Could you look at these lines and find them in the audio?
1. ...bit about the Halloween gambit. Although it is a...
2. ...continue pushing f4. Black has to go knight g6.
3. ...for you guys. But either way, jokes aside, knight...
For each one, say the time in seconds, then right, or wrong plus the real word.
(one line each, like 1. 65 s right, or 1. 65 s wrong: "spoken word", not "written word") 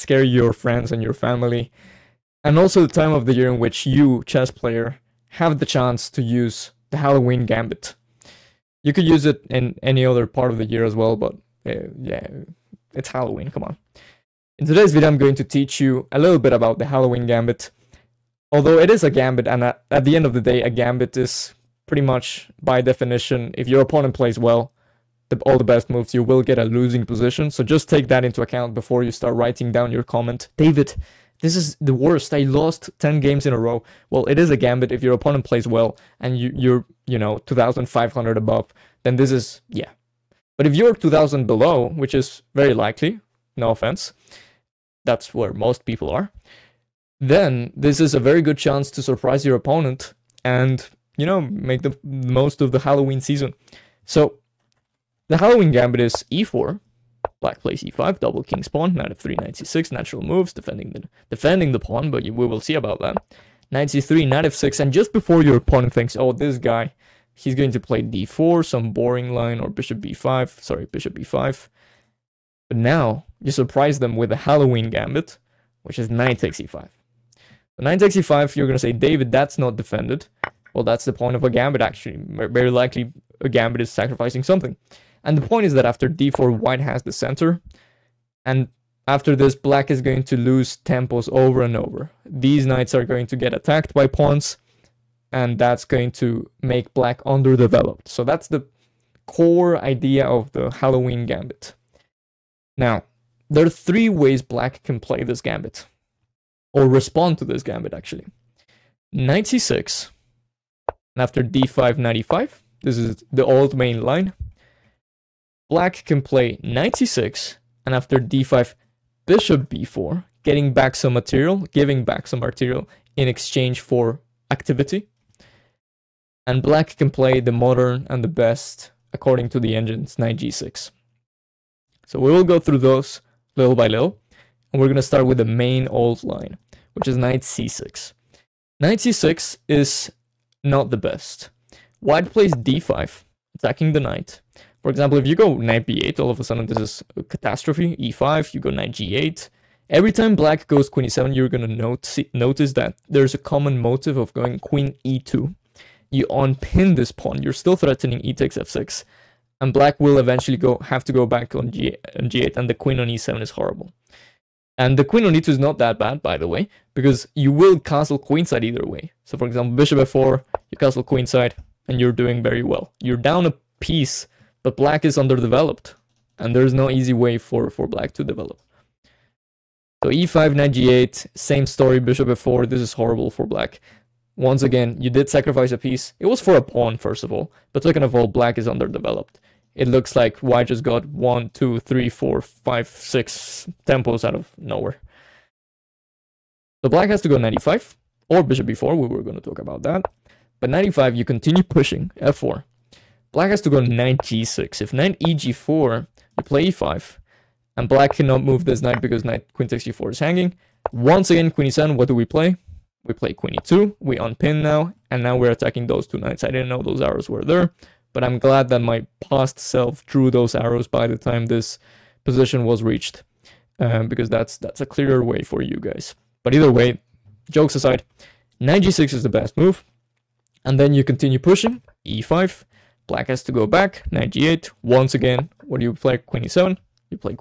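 1. 16 s right
2. 201 s right
3. 225 s right.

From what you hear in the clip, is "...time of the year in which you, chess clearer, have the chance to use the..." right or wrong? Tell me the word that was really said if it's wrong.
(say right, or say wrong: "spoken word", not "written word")
wrong: "player", not "clearer".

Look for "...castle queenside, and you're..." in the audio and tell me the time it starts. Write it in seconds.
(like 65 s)
170 s.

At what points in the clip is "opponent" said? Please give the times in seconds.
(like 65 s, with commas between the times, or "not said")
23 s, 35 s, 49 s, 65 s.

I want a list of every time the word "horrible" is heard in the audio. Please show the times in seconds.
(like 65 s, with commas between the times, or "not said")
163 s, 182 s.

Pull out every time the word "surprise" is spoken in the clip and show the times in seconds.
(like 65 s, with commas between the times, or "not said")
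49 s, 73 s.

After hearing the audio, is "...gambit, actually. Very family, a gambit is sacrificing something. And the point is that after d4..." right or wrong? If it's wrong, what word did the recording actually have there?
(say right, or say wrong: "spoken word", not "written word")
wrong: "likely", not "family".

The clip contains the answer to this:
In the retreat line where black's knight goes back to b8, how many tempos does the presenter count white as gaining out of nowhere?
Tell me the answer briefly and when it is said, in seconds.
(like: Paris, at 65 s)
6, at 192 s.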